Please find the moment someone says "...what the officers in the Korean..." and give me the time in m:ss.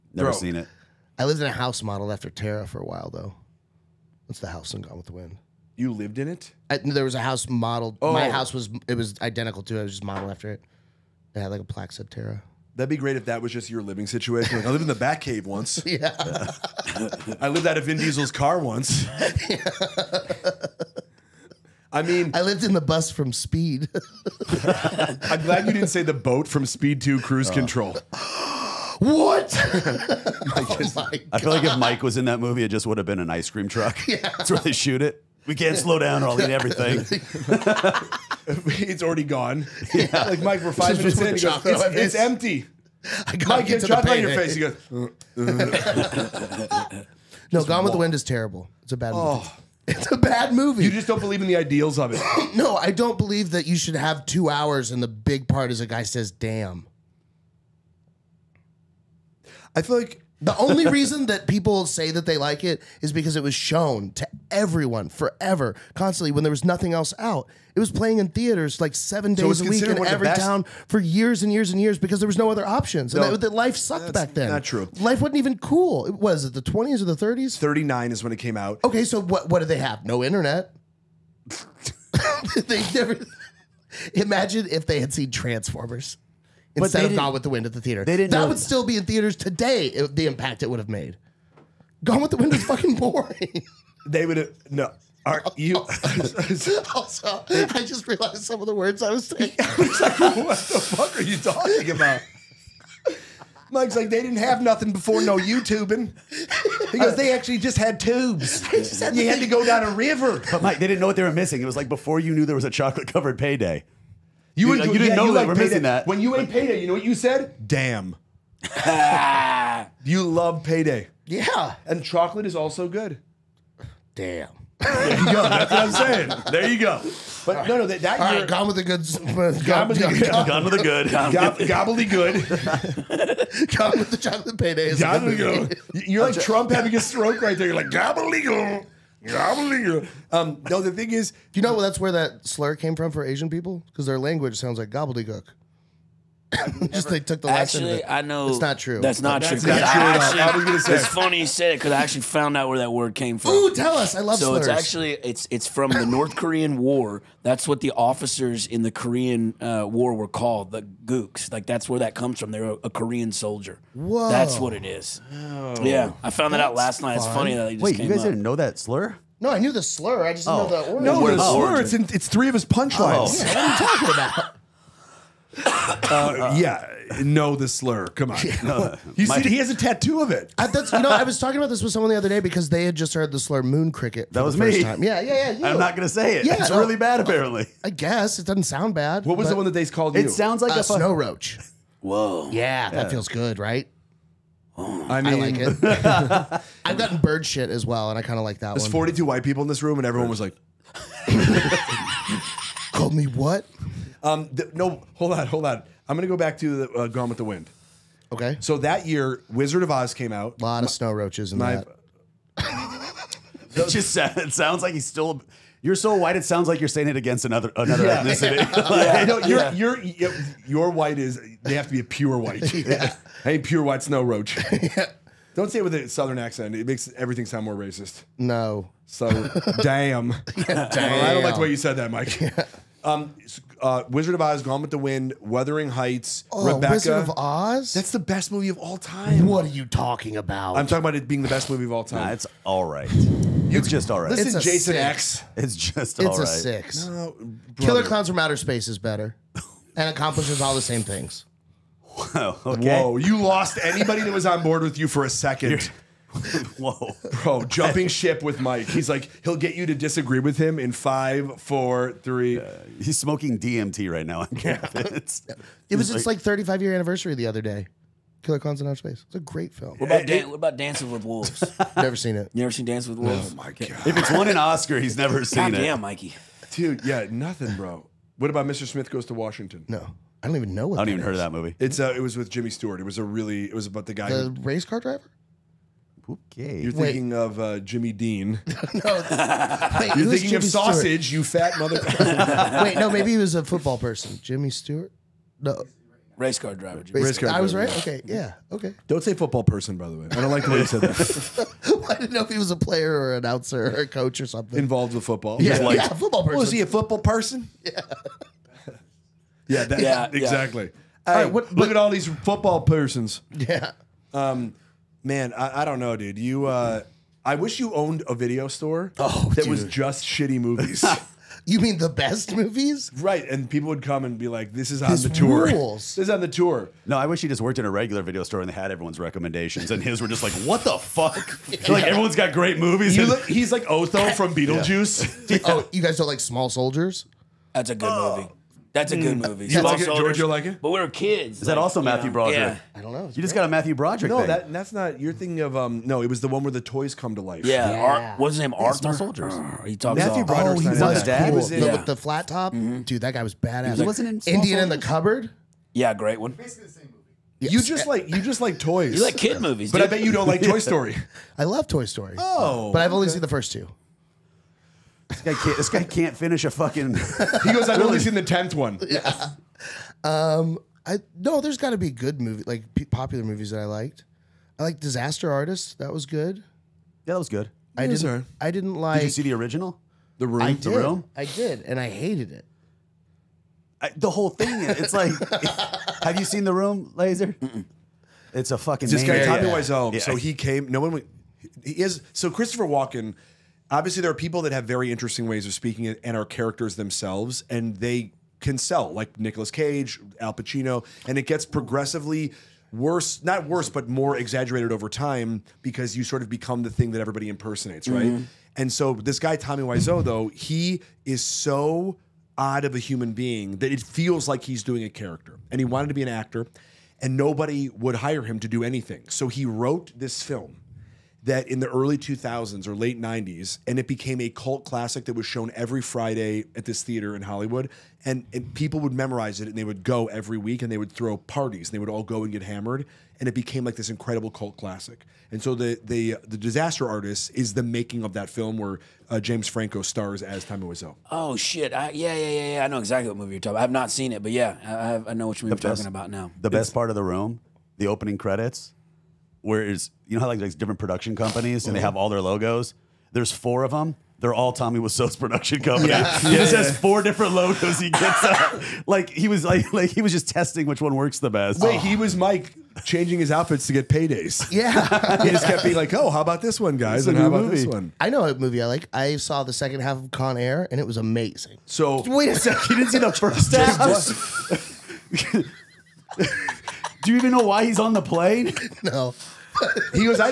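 2:37.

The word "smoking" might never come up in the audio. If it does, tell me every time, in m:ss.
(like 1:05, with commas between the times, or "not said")
4:23.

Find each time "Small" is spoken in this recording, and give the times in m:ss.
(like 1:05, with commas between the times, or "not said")
5:36, 5:54.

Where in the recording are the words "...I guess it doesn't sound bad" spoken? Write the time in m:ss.
3:07.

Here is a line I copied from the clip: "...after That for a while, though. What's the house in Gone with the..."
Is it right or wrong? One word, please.
wrong.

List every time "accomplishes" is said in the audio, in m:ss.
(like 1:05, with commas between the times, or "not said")
4:10.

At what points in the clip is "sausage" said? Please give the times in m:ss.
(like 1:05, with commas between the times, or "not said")
4:50.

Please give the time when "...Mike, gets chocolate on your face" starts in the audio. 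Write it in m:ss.
0:43.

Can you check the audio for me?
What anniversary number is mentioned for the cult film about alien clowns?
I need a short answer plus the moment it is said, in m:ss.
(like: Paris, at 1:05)
35, at 4:26.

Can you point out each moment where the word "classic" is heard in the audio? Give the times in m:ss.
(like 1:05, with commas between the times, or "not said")
7:04, 7:14.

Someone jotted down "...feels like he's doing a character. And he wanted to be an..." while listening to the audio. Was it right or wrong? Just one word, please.
right.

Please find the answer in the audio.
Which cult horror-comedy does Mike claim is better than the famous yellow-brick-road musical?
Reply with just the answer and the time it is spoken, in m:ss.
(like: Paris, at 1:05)
Killer Clowns from Outer Space, at 4:07.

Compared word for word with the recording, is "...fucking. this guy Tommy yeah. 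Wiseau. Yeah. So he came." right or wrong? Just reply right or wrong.
right.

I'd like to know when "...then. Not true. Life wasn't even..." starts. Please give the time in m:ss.
1:14.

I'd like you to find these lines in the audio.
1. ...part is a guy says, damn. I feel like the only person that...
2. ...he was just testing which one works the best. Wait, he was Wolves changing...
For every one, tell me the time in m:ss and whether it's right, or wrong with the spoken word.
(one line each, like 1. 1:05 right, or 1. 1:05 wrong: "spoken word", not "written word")
1. 0:55 wrong: "reason", not "person"
2. 7:40 wrong: "Mike", not "Wolves".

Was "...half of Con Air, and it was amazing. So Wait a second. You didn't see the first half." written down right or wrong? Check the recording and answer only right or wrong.
right.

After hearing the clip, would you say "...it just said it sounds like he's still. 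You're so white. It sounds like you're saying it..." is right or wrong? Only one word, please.
right.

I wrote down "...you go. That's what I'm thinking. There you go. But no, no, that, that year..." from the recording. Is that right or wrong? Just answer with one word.
wrong.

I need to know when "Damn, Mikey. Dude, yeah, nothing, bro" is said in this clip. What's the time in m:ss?
4:35.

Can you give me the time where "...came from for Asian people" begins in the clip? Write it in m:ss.
2:22.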